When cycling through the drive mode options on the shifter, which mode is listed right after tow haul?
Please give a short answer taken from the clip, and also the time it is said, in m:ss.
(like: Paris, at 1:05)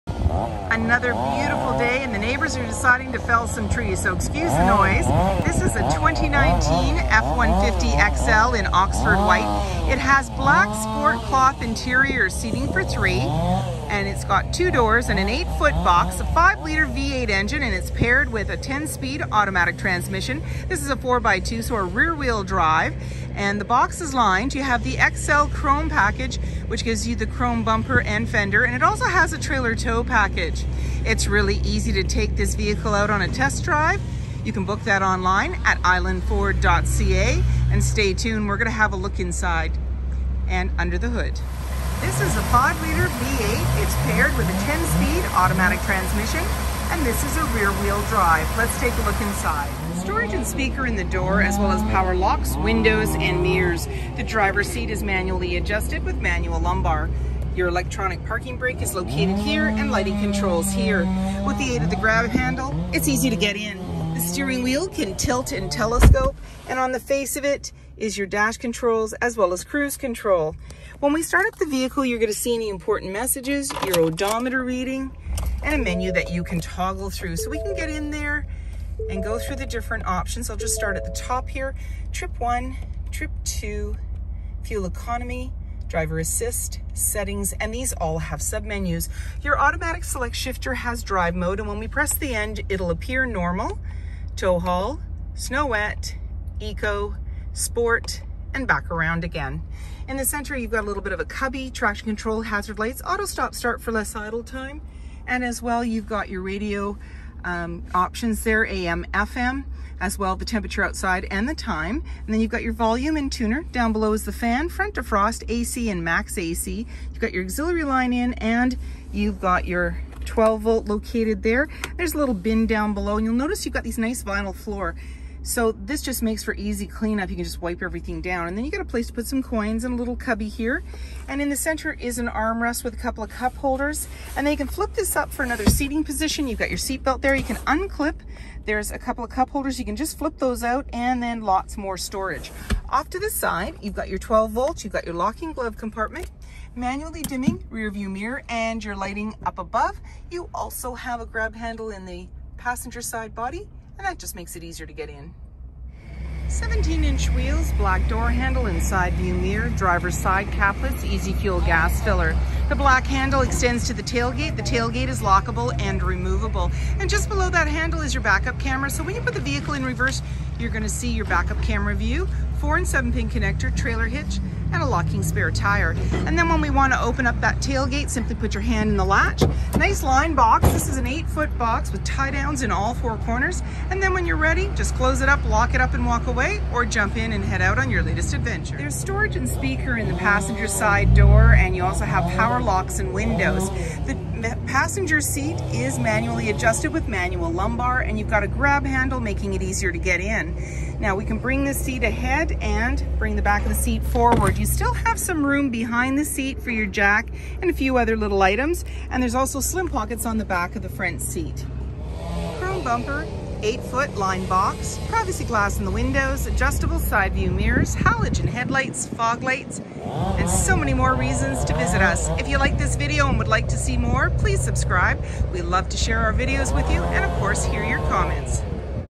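snow wet, at 1:35.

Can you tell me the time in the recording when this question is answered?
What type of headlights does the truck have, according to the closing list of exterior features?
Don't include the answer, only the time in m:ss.
3:37.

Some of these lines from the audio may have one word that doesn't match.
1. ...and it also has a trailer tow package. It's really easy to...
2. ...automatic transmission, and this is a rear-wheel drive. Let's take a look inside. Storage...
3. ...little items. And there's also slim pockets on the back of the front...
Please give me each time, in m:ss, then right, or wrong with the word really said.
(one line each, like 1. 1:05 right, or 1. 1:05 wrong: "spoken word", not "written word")
1. 0:28 right
2. 0:45 right
3. 3:28 right.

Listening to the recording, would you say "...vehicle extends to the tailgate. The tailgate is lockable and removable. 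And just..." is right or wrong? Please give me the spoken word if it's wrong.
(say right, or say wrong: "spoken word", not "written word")
wrong: "handle", not "vehicle".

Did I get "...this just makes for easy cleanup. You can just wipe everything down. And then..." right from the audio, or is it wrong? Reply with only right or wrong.
right.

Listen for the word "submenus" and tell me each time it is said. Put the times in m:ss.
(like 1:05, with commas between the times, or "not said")
1:28.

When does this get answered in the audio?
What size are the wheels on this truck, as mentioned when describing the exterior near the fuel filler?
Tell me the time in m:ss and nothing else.
2:36.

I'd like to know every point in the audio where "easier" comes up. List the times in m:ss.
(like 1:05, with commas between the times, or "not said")
2:34, 3:19.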